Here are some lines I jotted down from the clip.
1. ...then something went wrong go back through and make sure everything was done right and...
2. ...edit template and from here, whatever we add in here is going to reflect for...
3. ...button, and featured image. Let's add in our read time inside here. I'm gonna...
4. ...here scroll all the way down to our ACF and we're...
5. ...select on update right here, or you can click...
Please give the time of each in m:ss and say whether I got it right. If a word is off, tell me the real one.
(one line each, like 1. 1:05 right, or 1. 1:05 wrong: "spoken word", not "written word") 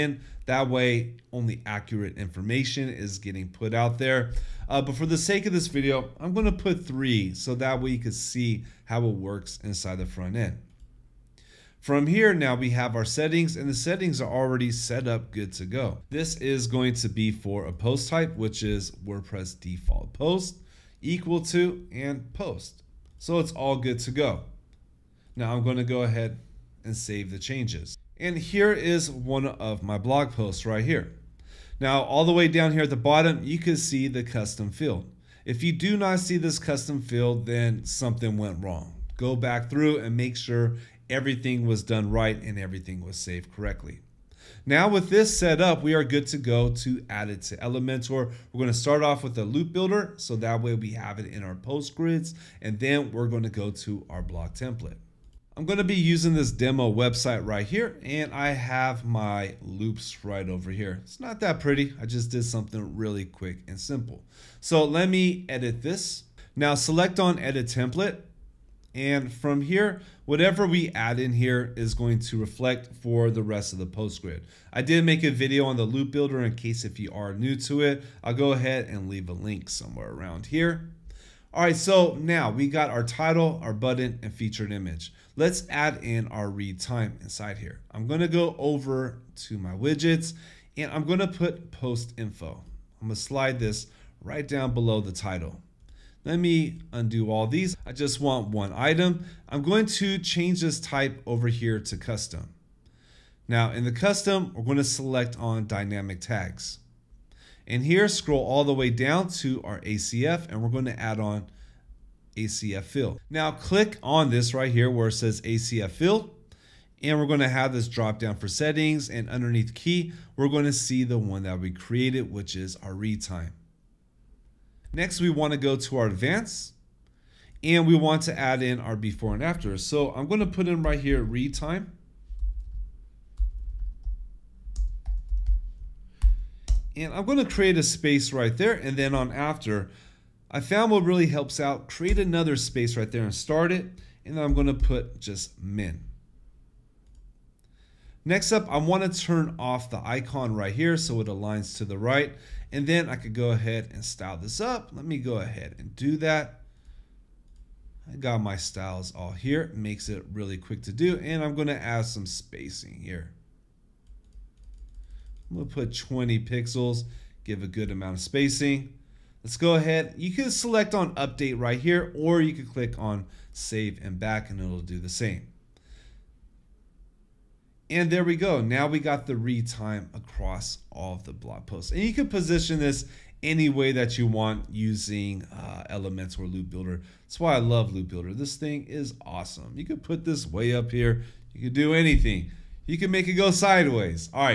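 1. 0:37 right
2. 1:07 right
3. 1:23 right
4. 1:47 right
5. 2:50 right.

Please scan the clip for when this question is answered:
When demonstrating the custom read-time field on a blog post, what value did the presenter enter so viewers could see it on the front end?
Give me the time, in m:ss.
0:06.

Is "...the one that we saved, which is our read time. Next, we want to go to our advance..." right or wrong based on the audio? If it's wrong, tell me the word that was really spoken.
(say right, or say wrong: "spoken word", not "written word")
wrong: "created", not "saved".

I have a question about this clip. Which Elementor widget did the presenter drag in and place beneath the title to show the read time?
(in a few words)
Post info.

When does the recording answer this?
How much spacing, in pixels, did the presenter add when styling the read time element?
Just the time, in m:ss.
2:45.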